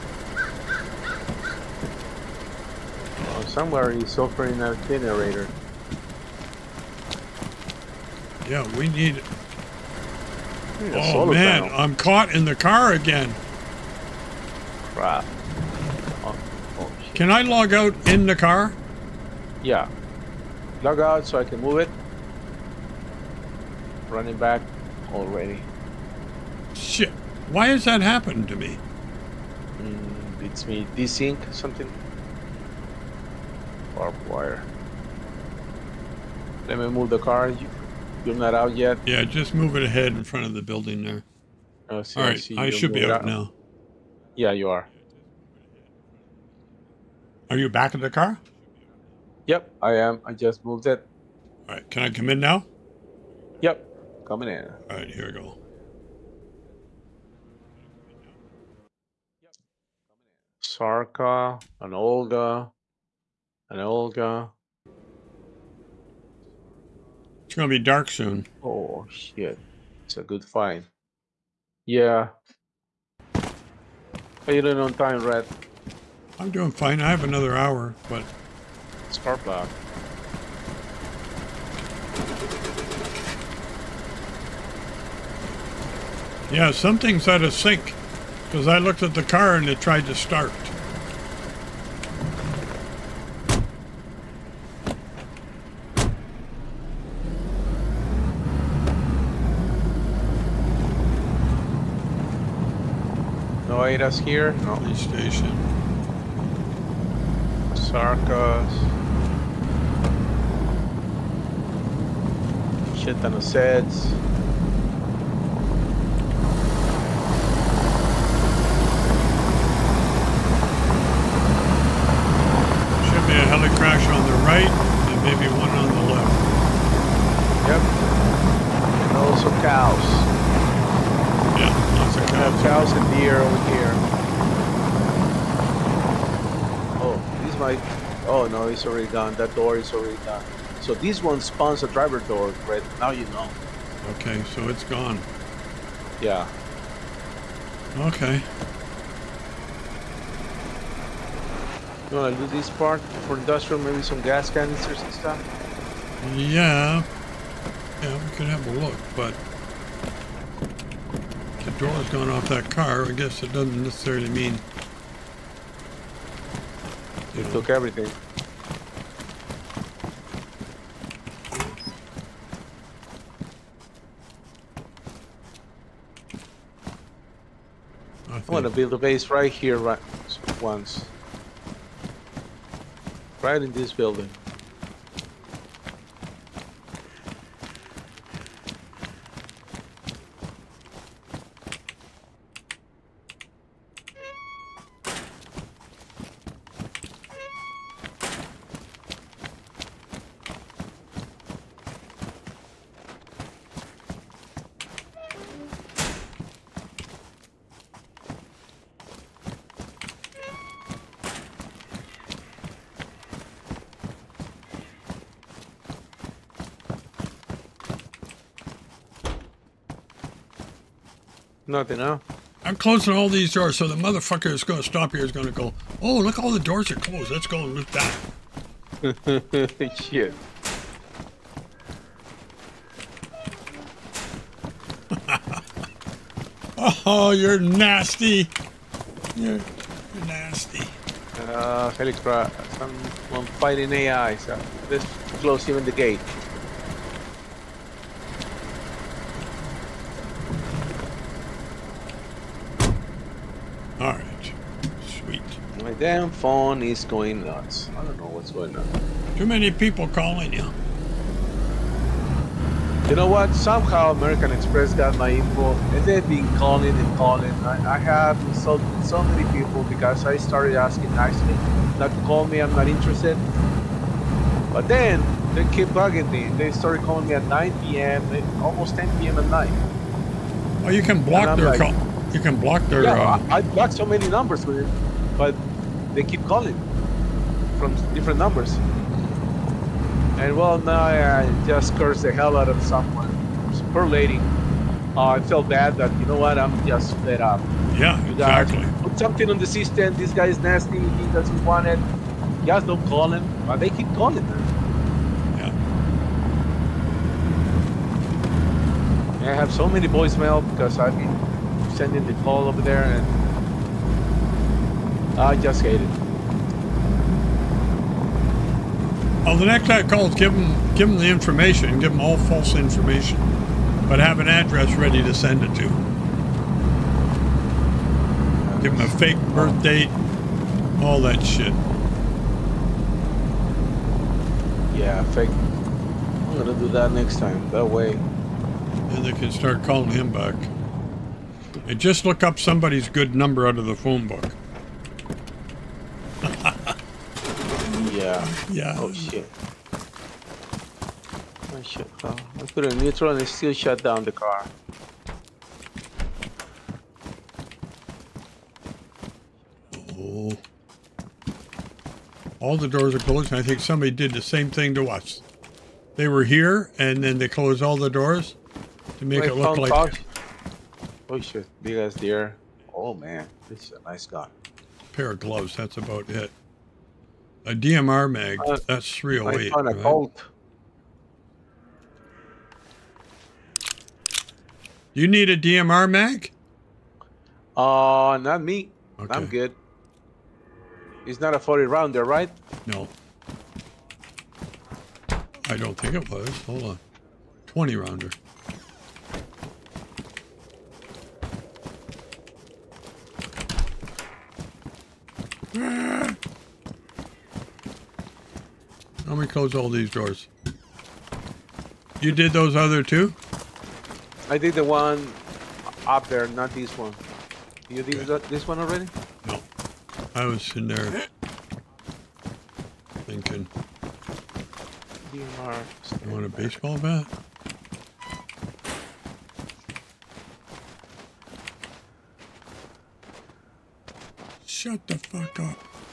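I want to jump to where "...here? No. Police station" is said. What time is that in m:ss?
1:44.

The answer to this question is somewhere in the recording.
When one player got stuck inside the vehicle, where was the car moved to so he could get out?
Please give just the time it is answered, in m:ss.
0:40.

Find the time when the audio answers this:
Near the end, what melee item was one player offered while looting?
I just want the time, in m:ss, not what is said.
7:06.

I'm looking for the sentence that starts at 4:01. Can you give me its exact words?
Uh, holy I'm fighting AI, so let's close even the gate.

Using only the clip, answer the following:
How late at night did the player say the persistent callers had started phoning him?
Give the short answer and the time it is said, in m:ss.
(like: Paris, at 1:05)
almost 10 p.m., at 4:38.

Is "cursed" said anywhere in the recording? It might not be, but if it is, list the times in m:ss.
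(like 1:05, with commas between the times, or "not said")
4:51.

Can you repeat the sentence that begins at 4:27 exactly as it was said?
I, I have insulted so many people because I started asking nicely, not to call me, I'm not interested.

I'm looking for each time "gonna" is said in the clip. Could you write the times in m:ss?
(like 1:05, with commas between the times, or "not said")
1:07, 5:36.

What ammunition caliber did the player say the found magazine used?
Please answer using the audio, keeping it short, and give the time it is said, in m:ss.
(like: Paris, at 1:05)
308, at 6:19.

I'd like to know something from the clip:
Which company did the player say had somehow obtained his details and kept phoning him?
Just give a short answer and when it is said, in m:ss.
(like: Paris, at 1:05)
American Express, at 4:24.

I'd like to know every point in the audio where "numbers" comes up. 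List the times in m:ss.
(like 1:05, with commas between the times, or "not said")
4:44, 4:48, 5:43.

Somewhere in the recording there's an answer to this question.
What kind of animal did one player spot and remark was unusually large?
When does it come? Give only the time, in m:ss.
6:12.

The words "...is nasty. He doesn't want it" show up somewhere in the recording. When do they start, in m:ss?
5:00.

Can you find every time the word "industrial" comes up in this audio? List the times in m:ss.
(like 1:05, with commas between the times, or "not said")
2:33.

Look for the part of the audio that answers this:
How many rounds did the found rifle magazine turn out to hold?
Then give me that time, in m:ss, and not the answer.
6:37.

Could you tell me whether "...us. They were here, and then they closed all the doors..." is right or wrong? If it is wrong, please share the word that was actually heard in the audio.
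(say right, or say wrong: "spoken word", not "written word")
right.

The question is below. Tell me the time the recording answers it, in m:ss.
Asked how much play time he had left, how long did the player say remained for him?
1:17.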